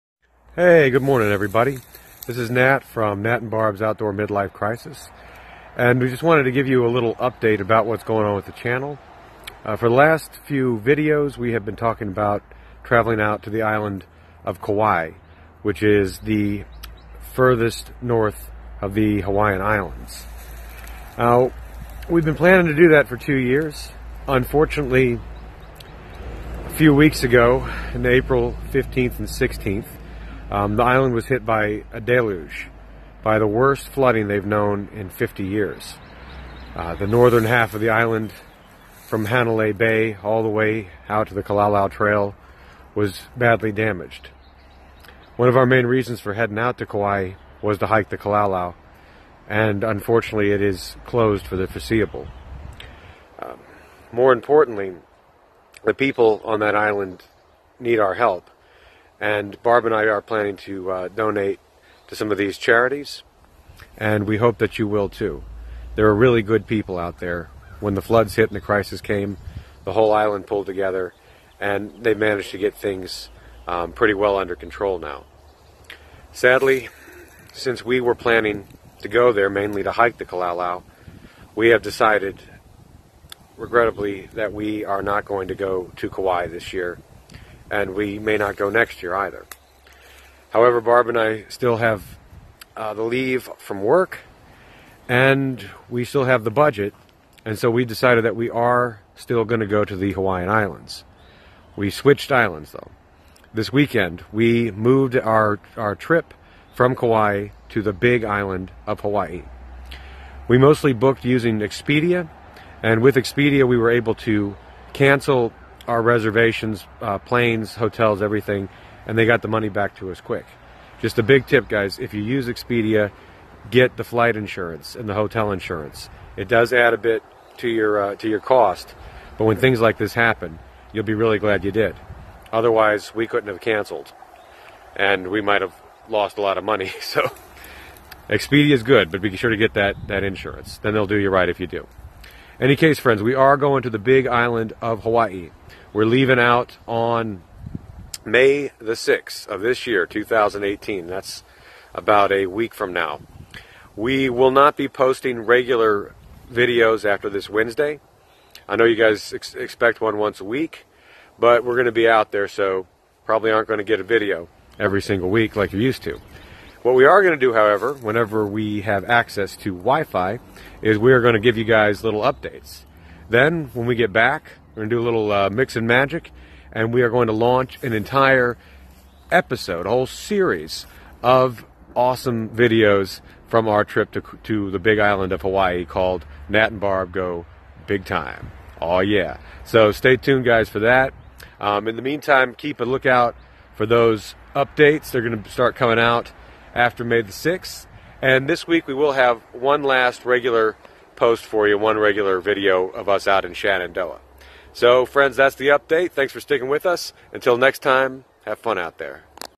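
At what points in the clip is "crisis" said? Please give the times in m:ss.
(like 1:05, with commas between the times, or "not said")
0:04, 1:08.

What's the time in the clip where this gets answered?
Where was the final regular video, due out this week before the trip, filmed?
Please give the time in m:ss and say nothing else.
3:23.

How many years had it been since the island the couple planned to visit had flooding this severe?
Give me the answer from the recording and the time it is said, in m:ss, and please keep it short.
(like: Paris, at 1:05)
50 years, at 0:35.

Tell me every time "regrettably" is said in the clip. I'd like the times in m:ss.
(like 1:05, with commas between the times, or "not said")
1:23.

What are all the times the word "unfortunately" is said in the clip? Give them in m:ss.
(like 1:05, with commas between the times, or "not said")
0:24, 0:49.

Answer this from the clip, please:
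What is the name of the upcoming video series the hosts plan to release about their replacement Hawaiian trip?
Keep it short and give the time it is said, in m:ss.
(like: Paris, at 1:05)
Nat and Barb Go Big Time, at 3:06.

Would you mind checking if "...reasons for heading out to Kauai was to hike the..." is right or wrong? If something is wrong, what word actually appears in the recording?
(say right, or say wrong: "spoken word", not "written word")
right.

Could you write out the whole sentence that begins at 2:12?
Otherwise, we couldn't have canceled, and we might have lost a lot of money.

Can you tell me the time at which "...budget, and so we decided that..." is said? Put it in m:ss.
1:36.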